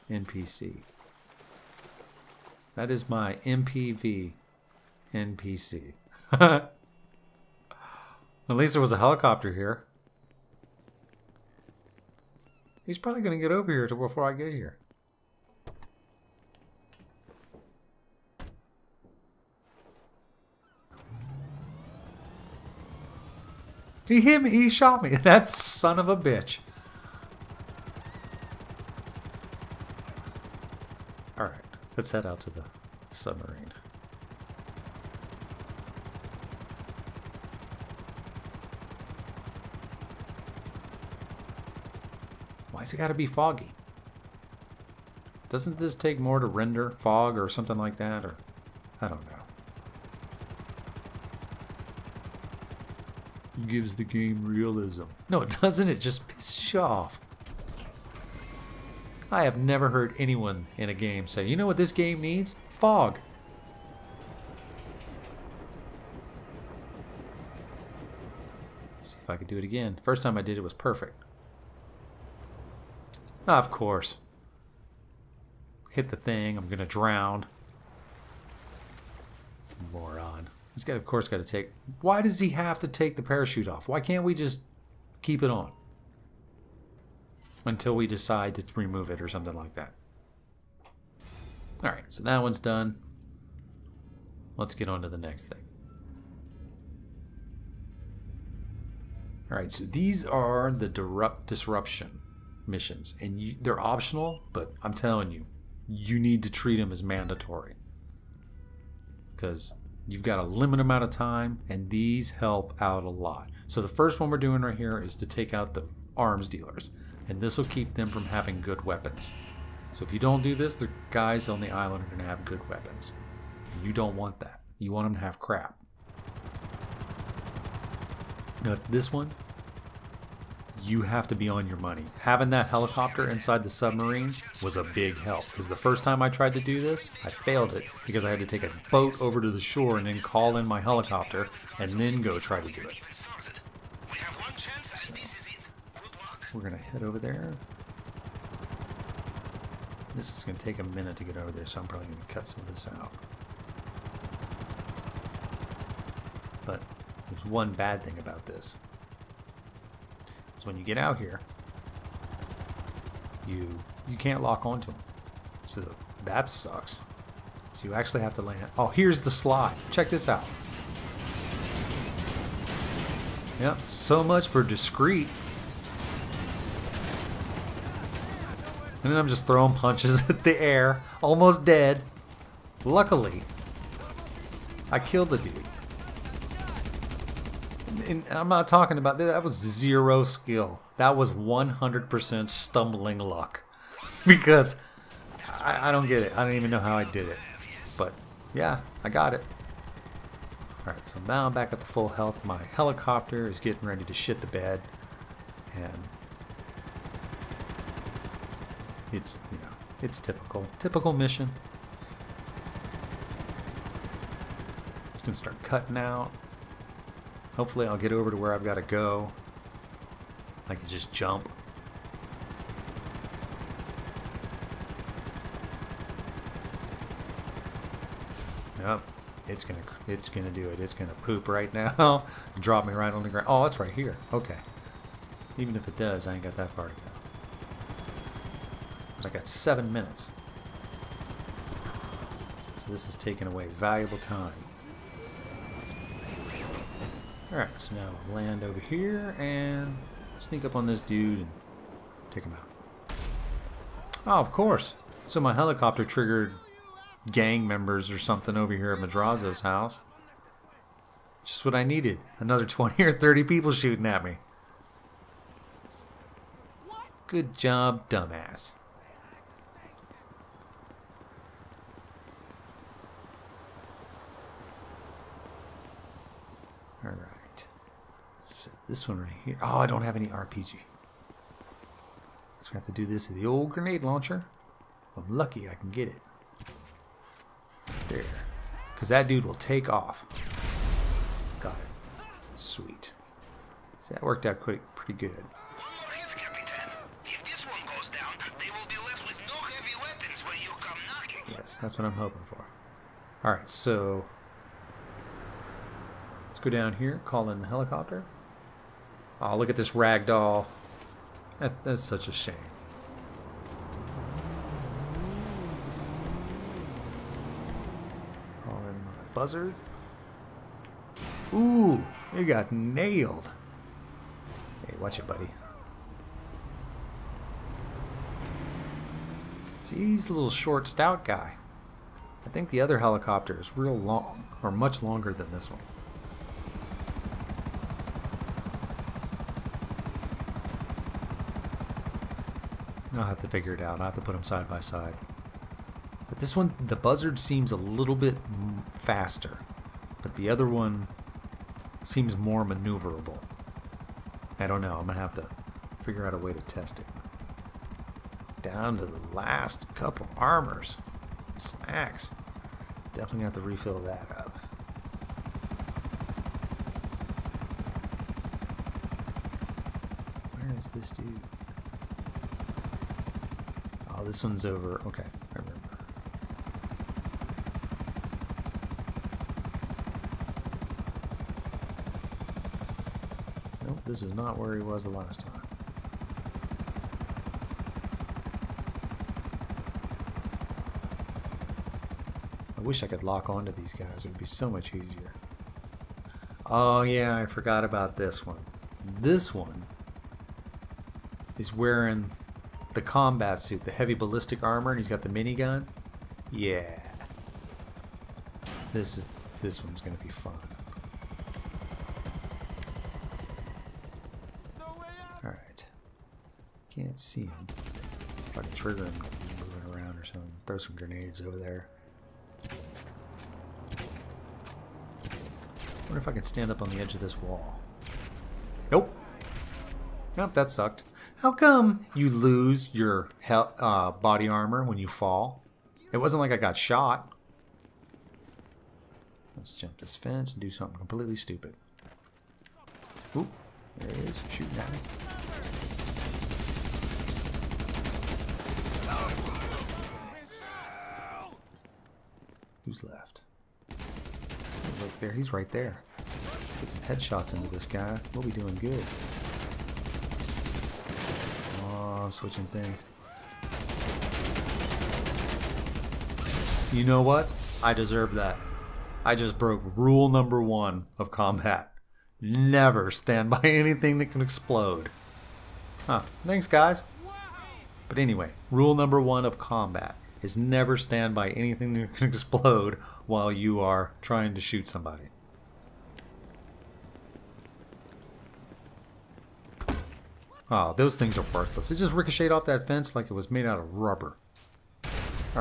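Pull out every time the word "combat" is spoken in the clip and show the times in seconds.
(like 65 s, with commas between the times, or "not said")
403 s, 471 s, 479 s.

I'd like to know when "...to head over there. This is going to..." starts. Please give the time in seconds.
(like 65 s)
146 s.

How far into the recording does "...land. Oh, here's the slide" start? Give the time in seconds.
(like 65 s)
168 s.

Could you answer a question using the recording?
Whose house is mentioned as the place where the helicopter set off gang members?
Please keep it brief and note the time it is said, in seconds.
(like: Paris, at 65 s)
Madrazo, at 258 s.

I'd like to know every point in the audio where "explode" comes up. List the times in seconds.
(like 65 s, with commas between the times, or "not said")
474 s, 482 s.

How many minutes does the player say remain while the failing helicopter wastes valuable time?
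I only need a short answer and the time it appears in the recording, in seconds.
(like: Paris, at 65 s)
7, at 239 s.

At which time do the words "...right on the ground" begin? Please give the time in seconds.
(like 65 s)
232 s.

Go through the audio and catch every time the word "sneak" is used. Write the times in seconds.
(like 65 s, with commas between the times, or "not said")
250 s.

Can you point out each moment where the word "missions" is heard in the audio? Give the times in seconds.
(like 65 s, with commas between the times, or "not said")
102 s, 211 s.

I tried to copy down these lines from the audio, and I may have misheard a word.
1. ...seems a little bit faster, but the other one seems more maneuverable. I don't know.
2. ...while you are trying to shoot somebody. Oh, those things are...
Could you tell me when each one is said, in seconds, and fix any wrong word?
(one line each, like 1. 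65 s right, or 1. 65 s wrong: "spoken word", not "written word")
1. 347 s right
2. 483 s right.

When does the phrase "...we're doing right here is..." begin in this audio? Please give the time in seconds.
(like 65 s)
114 s.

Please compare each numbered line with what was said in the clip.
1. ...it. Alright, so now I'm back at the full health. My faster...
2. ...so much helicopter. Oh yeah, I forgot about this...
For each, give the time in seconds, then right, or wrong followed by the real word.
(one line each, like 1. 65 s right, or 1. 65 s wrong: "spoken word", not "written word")
1. 199 s wrong: "helicopter", not "faster"
2. 394 s wrong: "easier", not "helicopter".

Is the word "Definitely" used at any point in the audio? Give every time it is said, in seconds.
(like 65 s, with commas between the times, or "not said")
363 s.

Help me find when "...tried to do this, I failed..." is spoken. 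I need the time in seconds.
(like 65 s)
136 s.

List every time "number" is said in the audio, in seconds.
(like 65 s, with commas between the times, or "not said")
470 s, 478 s.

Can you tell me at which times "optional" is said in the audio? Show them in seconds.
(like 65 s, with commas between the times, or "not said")
103 s.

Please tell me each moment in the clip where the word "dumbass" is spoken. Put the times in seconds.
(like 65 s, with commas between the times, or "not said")
268 s.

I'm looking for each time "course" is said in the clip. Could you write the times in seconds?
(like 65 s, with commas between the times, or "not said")
73 s, 81 s, 254 s.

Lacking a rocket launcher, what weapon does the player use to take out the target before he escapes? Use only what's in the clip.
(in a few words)
Grenade launcher.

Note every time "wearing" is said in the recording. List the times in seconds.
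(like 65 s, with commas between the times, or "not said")
401 s.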